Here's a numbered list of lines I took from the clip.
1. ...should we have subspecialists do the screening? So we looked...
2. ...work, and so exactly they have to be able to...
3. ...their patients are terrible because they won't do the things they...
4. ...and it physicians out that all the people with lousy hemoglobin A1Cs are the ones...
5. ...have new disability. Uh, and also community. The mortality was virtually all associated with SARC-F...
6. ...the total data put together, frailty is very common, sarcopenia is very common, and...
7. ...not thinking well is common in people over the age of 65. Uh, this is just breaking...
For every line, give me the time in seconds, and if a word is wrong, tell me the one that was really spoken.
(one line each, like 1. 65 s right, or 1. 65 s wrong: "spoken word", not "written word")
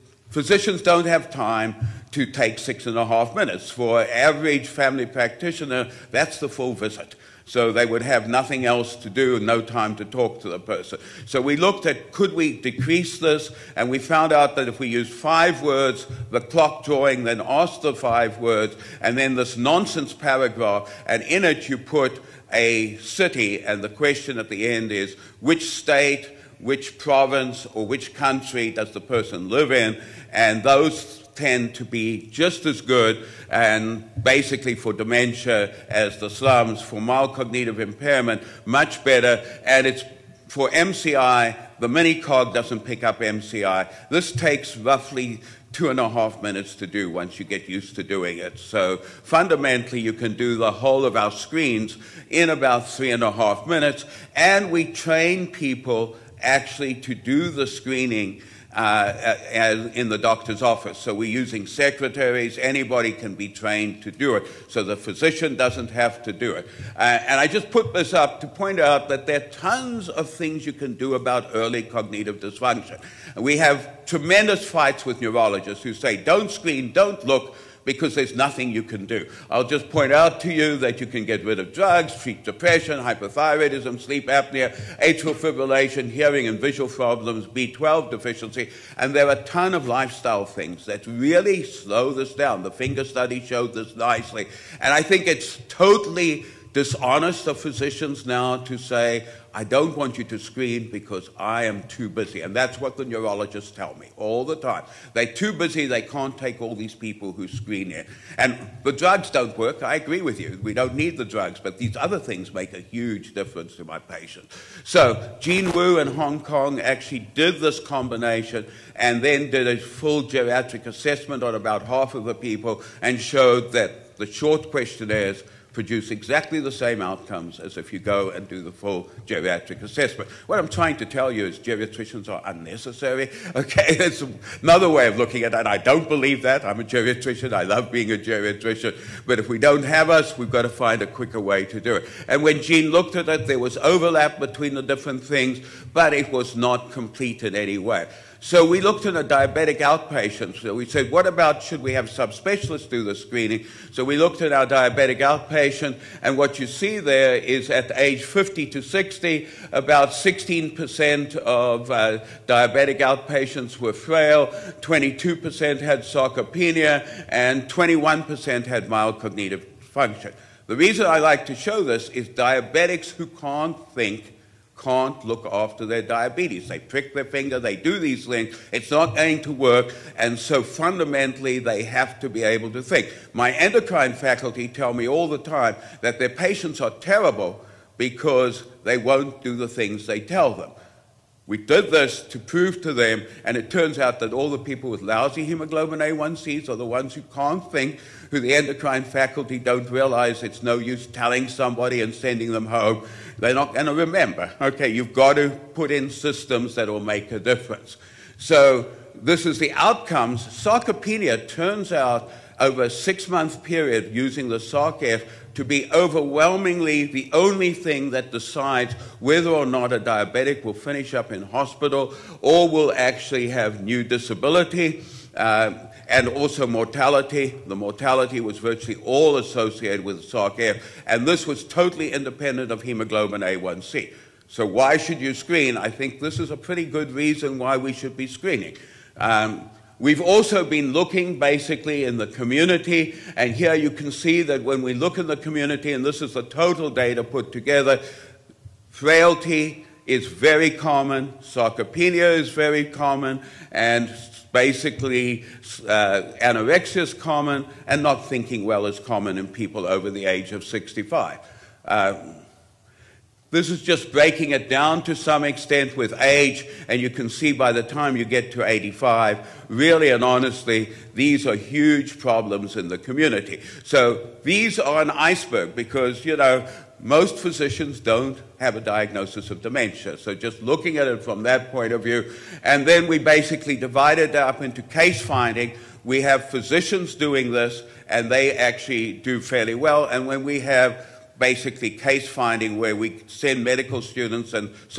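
1. 151 s right
2. 179 s wrong: "fundamentally", not "exactly"
3. 186 s right
4. 193 s wrong: "turns", not "physicians"
5. 223 s wrong: "mortality", not "community"
6. 246 s right
7. 258 s right.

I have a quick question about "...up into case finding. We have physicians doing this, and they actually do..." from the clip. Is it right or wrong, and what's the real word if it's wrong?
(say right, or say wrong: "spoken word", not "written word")
right.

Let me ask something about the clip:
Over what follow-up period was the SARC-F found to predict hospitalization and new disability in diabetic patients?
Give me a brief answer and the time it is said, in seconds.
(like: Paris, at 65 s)
6 months, at 212 s.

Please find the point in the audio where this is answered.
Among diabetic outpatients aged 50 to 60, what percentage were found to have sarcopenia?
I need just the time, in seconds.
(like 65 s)
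164 s.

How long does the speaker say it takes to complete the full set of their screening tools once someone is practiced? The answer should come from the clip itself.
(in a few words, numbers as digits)
3.5 minutes.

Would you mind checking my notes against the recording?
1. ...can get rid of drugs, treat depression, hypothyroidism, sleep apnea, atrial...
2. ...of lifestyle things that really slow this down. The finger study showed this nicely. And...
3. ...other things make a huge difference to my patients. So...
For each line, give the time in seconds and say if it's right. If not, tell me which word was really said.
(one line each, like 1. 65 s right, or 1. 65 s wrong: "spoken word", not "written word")
1. 81 s right
2. 89 s right
3. 111 s right.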